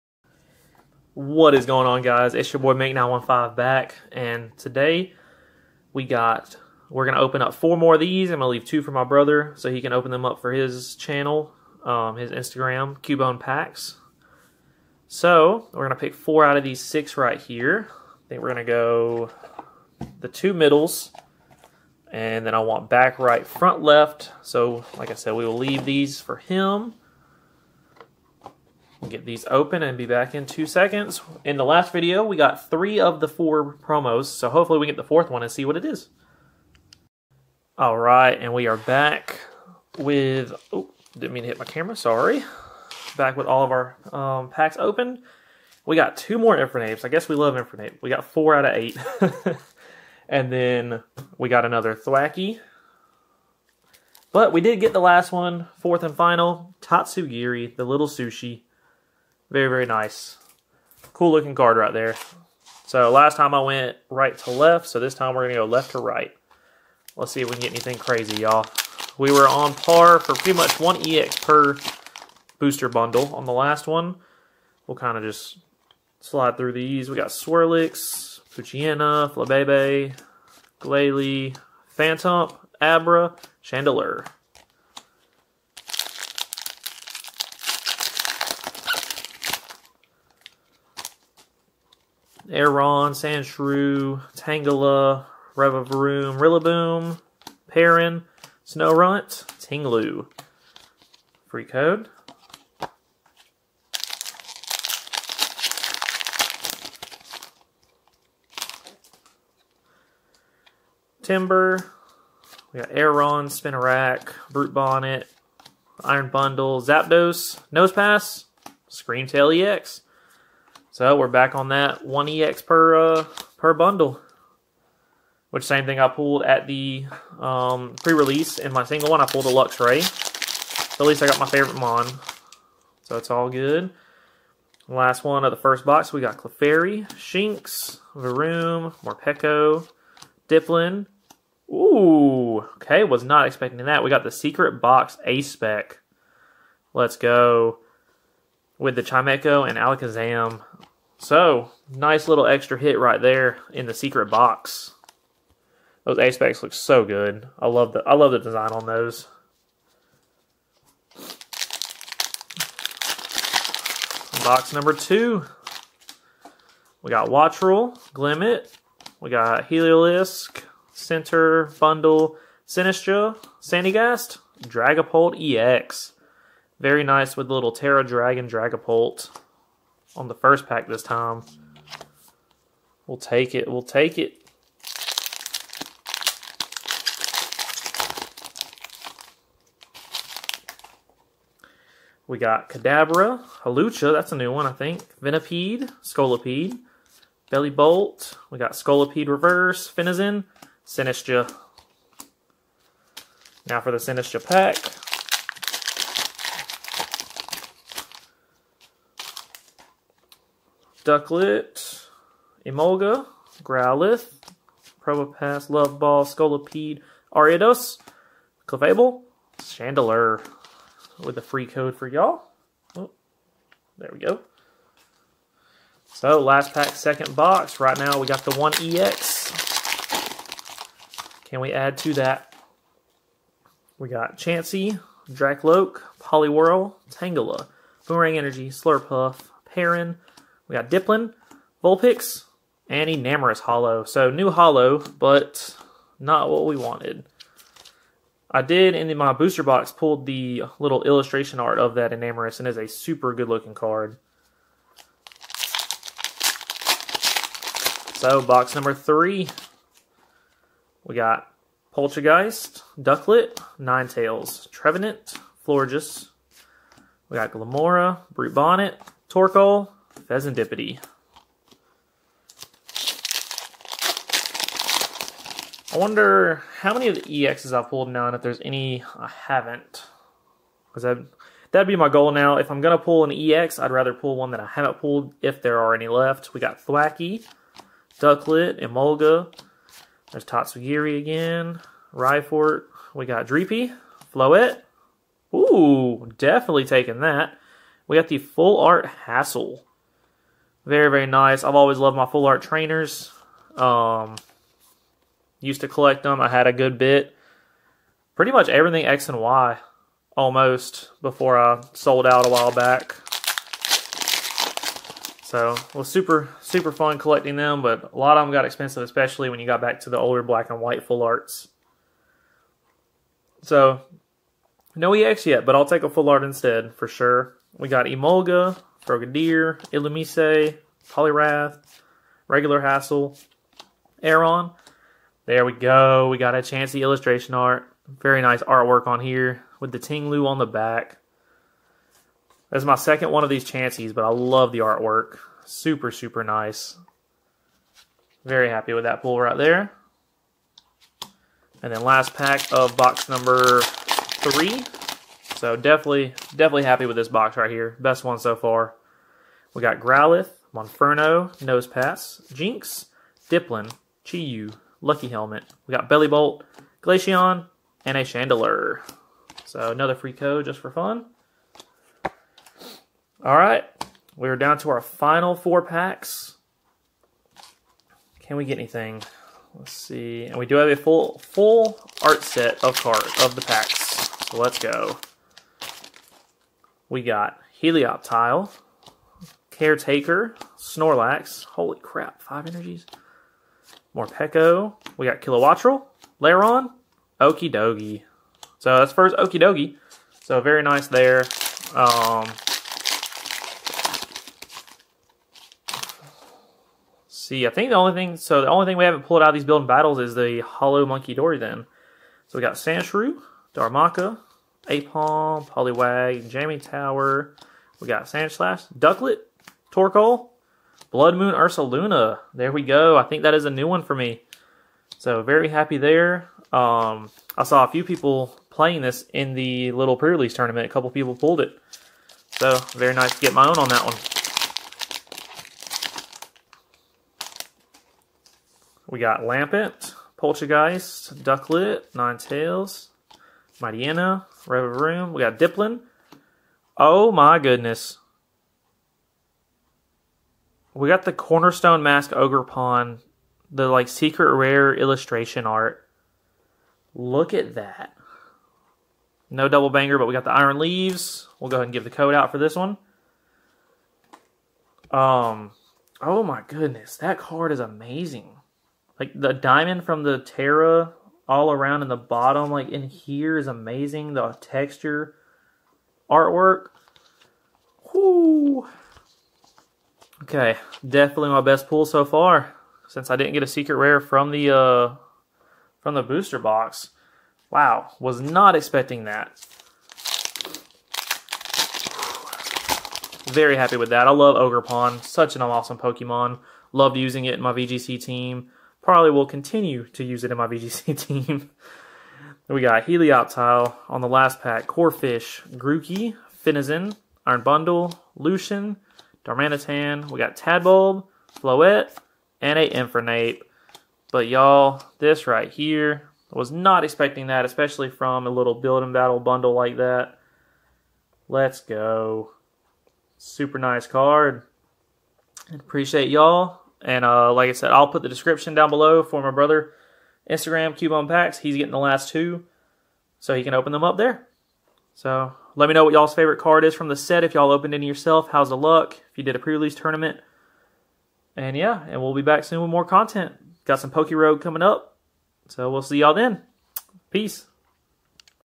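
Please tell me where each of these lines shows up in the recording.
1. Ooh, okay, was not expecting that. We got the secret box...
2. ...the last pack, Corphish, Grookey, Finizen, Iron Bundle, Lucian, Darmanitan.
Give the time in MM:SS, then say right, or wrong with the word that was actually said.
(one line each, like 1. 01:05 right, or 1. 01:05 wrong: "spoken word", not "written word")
1. 02:21 right
2. 08:24 right.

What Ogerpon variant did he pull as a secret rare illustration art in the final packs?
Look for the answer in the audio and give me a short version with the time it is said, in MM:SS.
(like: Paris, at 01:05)
Cornerstone Mask Ogerpon, at 07:31.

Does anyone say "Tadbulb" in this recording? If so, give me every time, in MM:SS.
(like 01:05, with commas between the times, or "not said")
08:30.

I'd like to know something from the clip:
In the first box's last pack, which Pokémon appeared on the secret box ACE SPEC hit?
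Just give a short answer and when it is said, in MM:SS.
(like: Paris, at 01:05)
Alakazam, at 02:29.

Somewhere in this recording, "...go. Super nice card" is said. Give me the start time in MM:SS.
08:41.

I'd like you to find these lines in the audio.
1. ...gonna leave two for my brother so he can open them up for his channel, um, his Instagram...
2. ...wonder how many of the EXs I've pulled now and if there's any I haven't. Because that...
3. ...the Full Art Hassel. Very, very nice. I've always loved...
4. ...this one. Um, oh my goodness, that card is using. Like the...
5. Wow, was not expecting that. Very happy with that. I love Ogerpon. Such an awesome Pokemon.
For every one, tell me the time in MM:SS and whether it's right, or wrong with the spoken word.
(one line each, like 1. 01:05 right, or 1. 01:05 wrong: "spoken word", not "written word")
1. 00:08 right
2. 04:35 right
3. 04:58 right
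4. 07:42 wrong: "amazing", not "using"
5. 08:07 right.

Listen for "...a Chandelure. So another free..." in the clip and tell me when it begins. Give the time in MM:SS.
06:08.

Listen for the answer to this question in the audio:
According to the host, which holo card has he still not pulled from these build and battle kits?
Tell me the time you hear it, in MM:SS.
06:50.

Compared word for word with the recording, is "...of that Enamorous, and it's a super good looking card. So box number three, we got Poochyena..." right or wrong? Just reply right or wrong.
wrong.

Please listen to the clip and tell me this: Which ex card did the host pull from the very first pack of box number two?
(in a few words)
Dragapult ex.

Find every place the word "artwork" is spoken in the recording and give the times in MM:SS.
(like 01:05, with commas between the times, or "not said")
05:38, 05:44, 07:56.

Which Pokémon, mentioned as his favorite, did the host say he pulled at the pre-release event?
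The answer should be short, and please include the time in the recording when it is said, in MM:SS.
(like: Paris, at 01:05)
Luxray, at 02:09.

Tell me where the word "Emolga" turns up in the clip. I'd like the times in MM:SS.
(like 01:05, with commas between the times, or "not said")
03:32, 04:48, 05:28.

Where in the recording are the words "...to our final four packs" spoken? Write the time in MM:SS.
06:14.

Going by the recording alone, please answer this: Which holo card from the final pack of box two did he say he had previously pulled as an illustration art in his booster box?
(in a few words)
Enamorus.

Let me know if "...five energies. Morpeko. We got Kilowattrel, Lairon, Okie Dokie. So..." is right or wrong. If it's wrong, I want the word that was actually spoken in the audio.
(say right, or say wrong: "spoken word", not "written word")
right.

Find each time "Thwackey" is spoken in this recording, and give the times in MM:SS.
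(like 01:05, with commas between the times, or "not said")
00:51, 04:46.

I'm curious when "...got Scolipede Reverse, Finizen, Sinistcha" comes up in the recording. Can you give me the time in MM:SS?
03:18.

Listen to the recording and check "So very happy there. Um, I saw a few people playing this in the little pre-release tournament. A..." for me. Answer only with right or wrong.
right.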